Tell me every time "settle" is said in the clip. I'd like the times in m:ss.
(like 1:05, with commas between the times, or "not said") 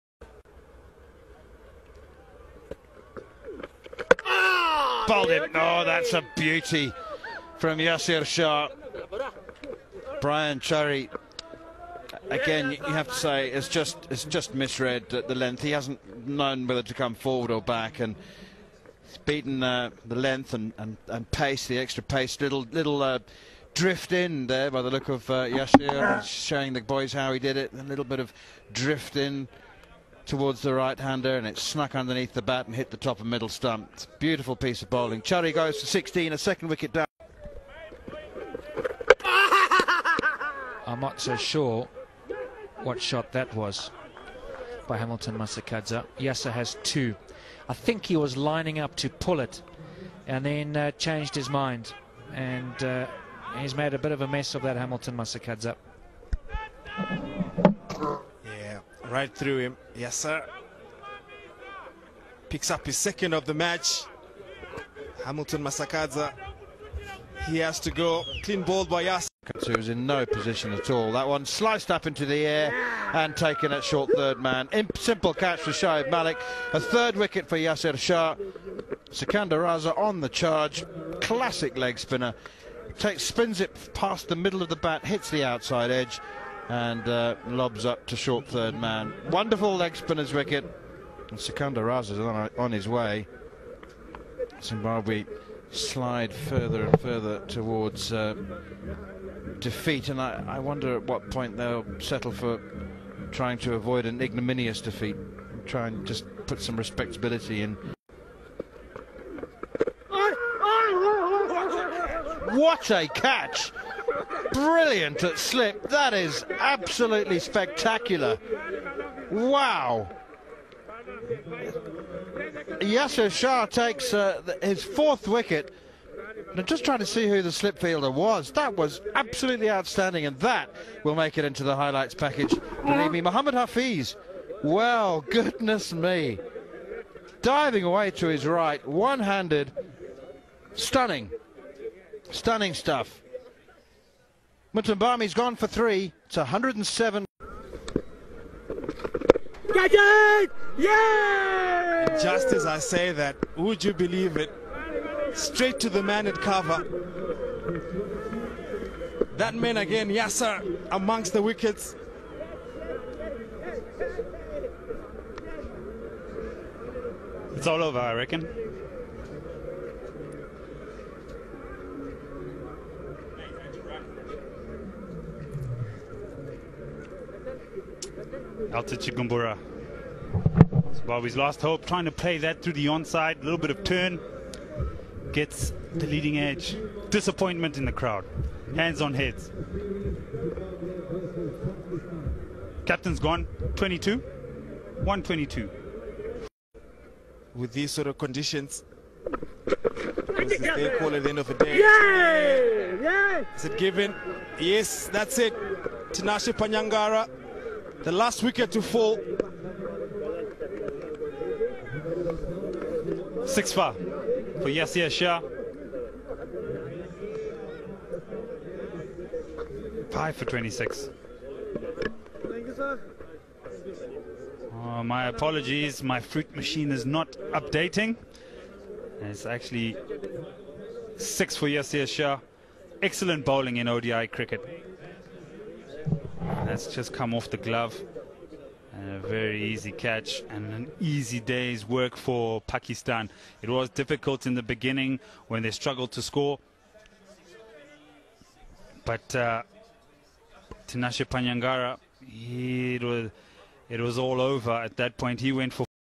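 1:41.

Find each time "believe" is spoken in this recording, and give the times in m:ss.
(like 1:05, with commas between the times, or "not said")
2:12, 2:33.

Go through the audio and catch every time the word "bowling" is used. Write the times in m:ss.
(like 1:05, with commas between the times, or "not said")
0:34, 3:53.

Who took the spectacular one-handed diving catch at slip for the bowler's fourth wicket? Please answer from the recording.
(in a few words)
Mohammad Hafeez.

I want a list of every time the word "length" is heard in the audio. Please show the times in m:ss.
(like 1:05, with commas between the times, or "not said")
0:15, 0:20.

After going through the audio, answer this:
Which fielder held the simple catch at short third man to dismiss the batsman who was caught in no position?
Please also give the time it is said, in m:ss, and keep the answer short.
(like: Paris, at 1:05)
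Shoaib Malik, at 1:15.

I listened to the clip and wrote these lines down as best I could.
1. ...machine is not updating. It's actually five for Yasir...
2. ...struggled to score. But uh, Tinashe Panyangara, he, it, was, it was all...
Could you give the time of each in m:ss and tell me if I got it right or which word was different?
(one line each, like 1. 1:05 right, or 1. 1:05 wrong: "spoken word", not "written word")
1. 3:46 wrong: "six", not "five"
2. 4:05 right.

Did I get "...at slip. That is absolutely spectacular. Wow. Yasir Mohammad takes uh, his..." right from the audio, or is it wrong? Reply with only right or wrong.
wrong.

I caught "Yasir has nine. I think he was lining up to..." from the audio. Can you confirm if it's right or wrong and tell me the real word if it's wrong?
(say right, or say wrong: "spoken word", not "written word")
wrong: "two", not "nine".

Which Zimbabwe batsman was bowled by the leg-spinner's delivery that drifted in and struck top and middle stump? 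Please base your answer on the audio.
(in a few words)
Brian Chari.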